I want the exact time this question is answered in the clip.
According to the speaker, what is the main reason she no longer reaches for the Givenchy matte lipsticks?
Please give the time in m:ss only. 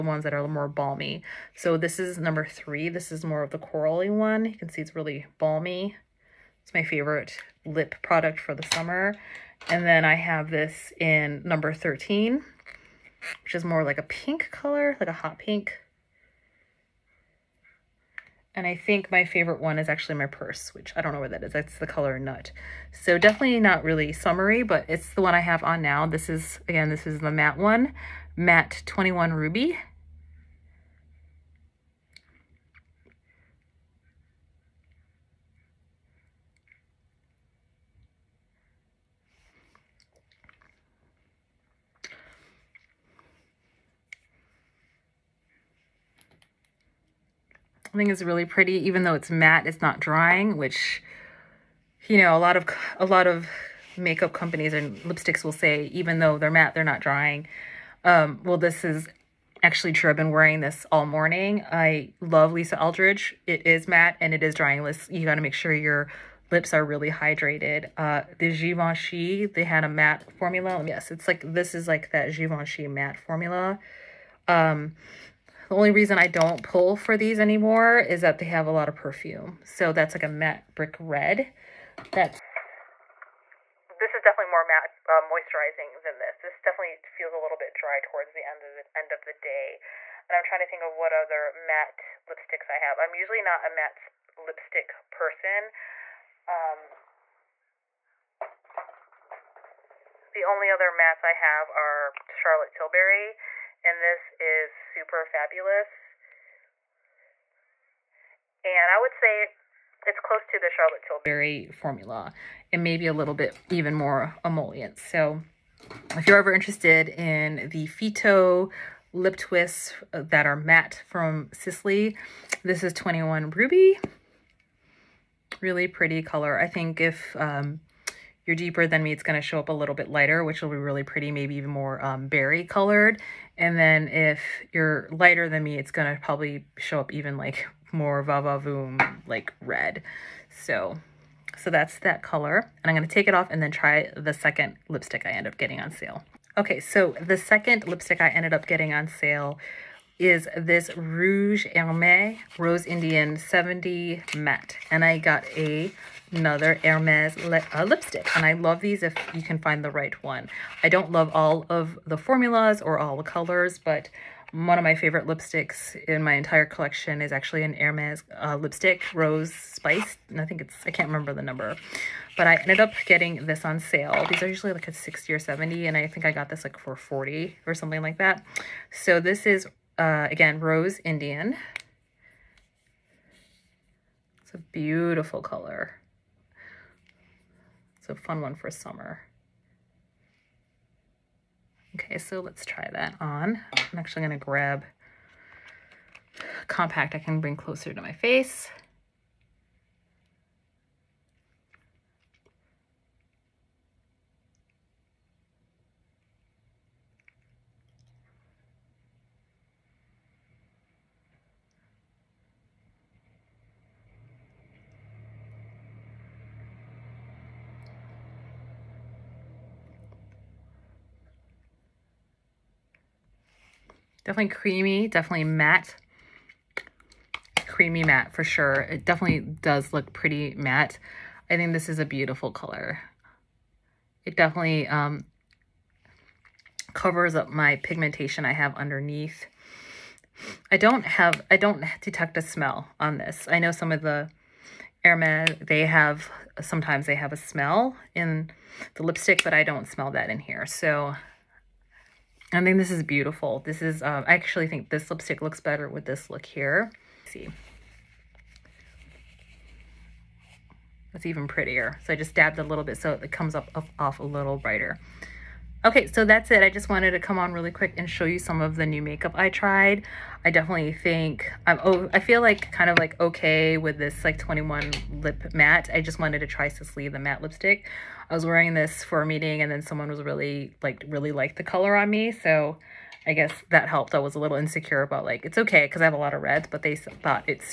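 1:18.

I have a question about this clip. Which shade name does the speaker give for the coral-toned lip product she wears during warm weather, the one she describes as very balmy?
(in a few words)
number 3.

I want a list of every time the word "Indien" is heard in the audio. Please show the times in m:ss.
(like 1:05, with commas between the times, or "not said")
2:32, 3:01.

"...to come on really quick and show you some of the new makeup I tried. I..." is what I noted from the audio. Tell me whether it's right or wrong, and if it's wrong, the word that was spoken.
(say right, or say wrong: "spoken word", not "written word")
right.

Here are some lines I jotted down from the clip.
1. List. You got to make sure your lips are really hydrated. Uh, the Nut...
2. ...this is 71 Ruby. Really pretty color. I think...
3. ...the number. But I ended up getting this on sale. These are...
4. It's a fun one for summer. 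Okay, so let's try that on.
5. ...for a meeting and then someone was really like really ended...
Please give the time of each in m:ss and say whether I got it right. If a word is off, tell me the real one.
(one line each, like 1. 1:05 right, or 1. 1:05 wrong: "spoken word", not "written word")
1. 1:04 wrong: "Givenchy", not "Nut"
2. 2:02 wrong: "21", not "71"
3. 2:51 right
4. 3:07 right
5. 4:39 wrong: "liked", not "ended".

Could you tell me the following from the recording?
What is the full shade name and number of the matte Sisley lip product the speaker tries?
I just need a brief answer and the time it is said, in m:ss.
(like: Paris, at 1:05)
21 Ruby, at 0:28.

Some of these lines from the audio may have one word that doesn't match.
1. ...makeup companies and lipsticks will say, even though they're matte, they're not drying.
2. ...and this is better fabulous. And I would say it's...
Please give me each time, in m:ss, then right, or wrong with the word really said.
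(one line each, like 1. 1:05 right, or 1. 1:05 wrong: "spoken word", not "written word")
1. 0:53 right
2. 1:43 wrong: "super", not "better".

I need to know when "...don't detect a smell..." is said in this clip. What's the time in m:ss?
4:01.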